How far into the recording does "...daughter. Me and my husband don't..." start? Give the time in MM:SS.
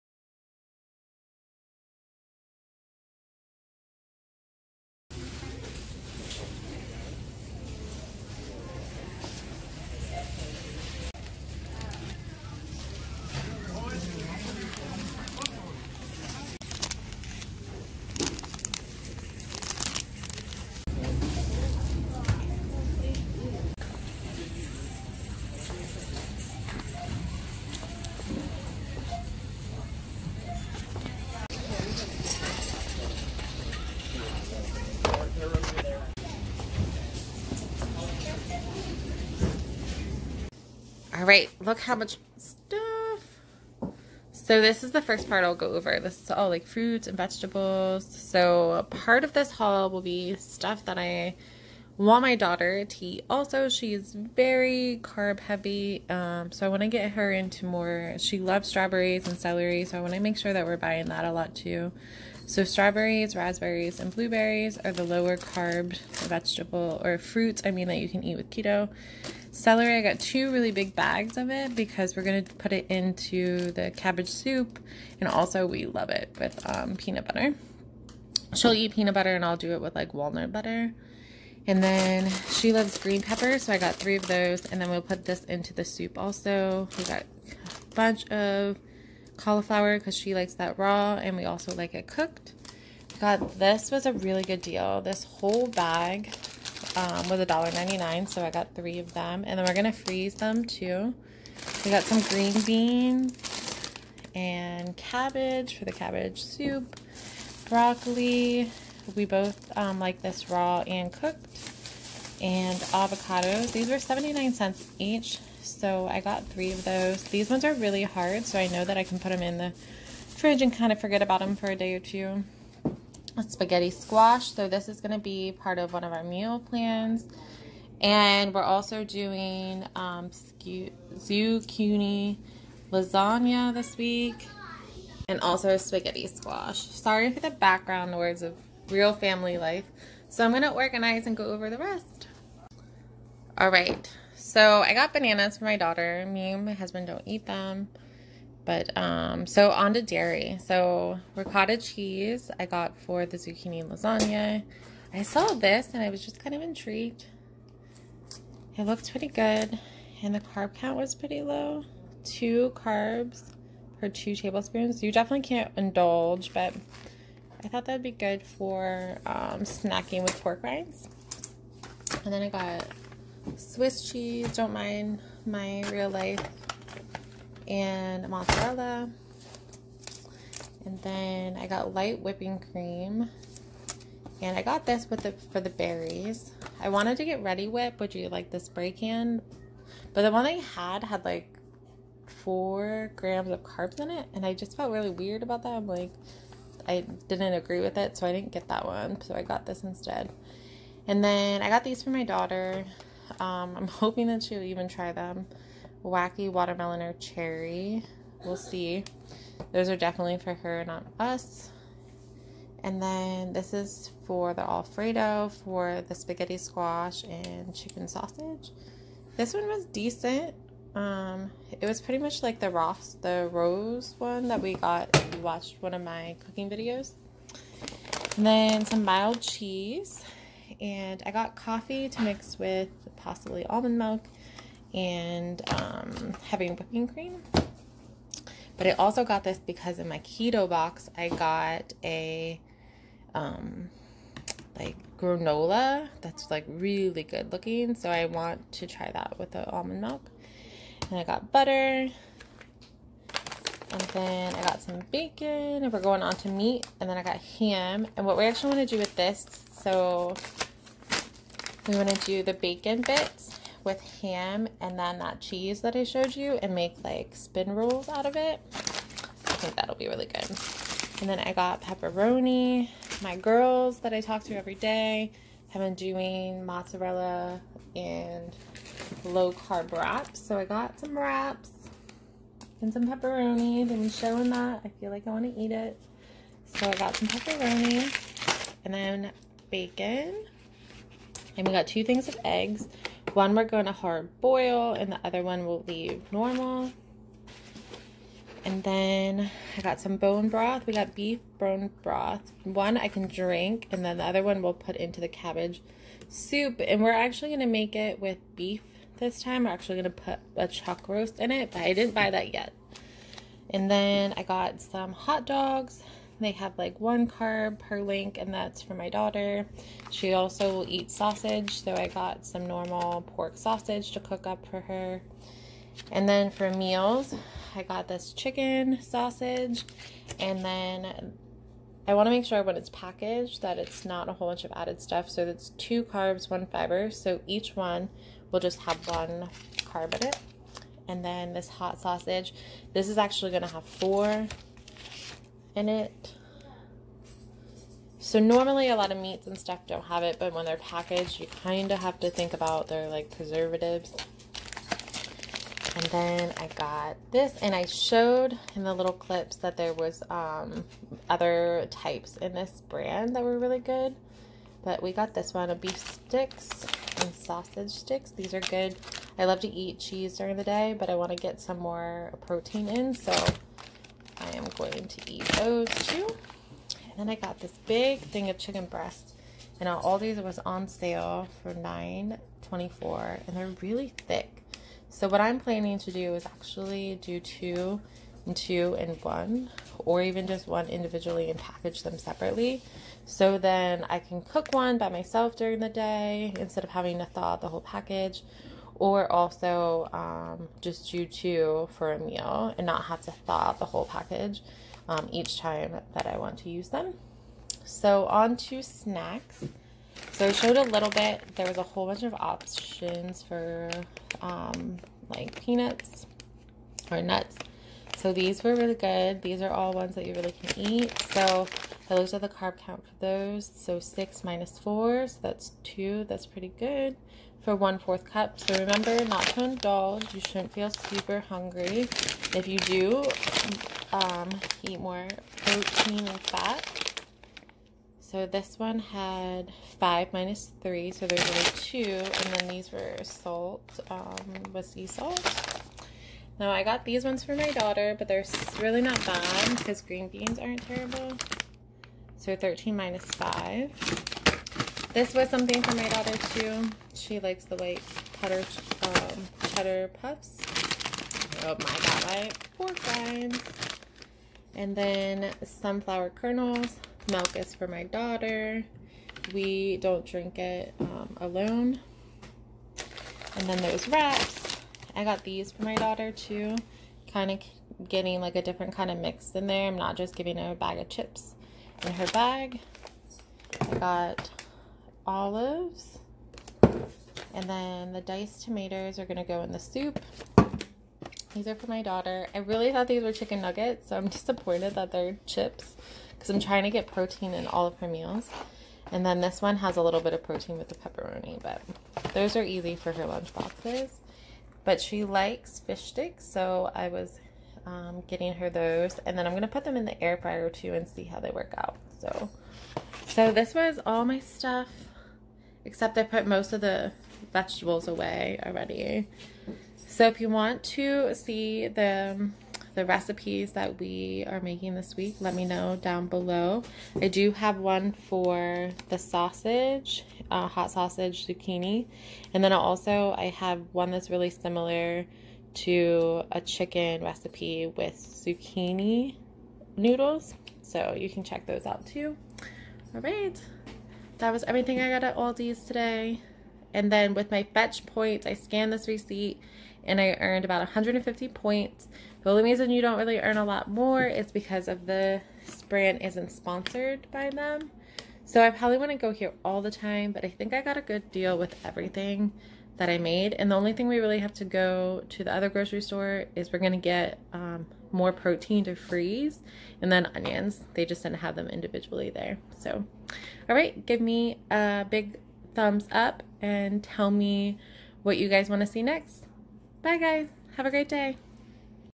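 02:25.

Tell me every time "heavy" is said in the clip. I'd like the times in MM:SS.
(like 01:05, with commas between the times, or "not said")
00:55, 03:56.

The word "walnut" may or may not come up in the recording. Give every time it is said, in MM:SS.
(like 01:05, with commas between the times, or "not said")
01:20.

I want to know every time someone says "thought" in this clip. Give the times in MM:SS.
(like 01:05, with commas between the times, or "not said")
02:47, 08:12.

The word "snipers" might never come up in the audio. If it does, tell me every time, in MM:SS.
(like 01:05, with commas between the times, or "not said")
not said.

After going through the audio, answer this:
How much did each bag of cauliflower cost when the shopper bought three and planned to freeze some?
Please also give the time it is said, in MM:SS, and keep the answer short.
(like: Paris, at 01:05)
$1.99, at 01:37.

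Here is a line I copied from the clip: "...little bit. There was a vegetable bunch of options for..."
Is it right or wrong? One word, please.
wrong.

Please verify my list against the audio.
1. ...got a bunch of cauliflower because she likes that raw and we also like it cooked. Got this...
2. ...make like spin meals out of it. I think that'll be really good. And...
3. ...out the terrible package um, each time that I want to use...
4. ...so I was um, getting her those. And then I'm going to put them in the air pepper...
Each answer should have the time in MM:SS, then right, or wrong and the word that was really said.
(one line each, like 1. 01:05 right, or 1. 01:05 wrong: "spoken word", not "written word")
1. 01:27 right
2. 04:26 wrong: "rolls", not "meals"
3. 06:43 wrong: "whole", not "terrible"
4. 08:26 wrong: "fryer", not "pepper".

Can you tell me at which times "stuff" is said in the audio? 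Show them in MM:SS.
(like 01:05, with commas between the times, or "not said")
00:42, 00:50, 05:34, 05:49, 08:34.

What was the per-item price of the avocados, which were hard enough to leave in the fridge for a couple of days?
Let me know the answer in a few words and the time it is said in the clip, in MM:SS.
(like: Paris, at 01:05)
79 cents, at 01:53.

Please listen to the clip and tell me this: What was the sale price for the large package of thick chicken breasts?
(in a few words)
$9.24.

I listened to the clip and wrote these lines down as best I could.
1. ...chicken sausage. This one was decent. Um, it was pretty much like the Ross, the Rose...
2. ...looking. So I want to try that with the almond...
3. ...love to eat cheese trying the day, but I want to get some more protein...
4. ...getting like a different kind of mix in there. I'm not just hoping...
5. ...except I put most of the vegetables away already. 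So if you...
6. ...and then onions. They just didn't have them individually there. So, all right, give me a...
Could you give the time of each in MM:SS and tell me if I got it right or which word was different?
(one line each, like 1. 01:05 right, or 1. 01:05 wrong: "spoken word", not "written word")
1. 03:37 right
2. 04:07 right
3. 06:09 wrong: "during", not "trying"
4. 07:58 wrong: "giving", not "hoping"
5. 08:35 right
6. 09:30 right.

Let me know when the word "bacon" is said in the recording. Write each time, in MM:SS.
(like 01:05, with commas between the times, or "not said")
04:15, 04:22, 04:49.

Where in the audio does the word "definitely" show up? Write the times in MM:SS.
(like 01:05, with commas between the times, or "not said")
02:45, 03:29.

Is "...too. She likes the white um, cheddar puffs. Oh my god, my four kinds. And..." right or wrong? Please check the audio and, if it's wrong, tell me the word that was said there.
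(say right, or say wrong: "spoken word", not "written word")
right.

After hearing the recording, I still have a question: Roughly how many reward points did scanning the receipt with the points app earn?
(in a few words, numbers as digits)
150.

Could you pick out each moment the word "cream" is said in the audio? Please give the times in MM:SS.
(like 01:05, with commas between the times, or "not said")
03:02, 03:57.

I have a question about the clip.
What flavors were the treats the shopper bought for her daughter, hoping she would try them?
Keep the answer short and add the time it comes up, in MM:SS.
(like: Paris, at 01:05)
Wacky watermelon or cherry, at 03:26.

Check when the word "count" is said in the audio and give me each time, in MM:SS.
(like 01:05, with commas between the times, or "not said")
02:40, 07:02.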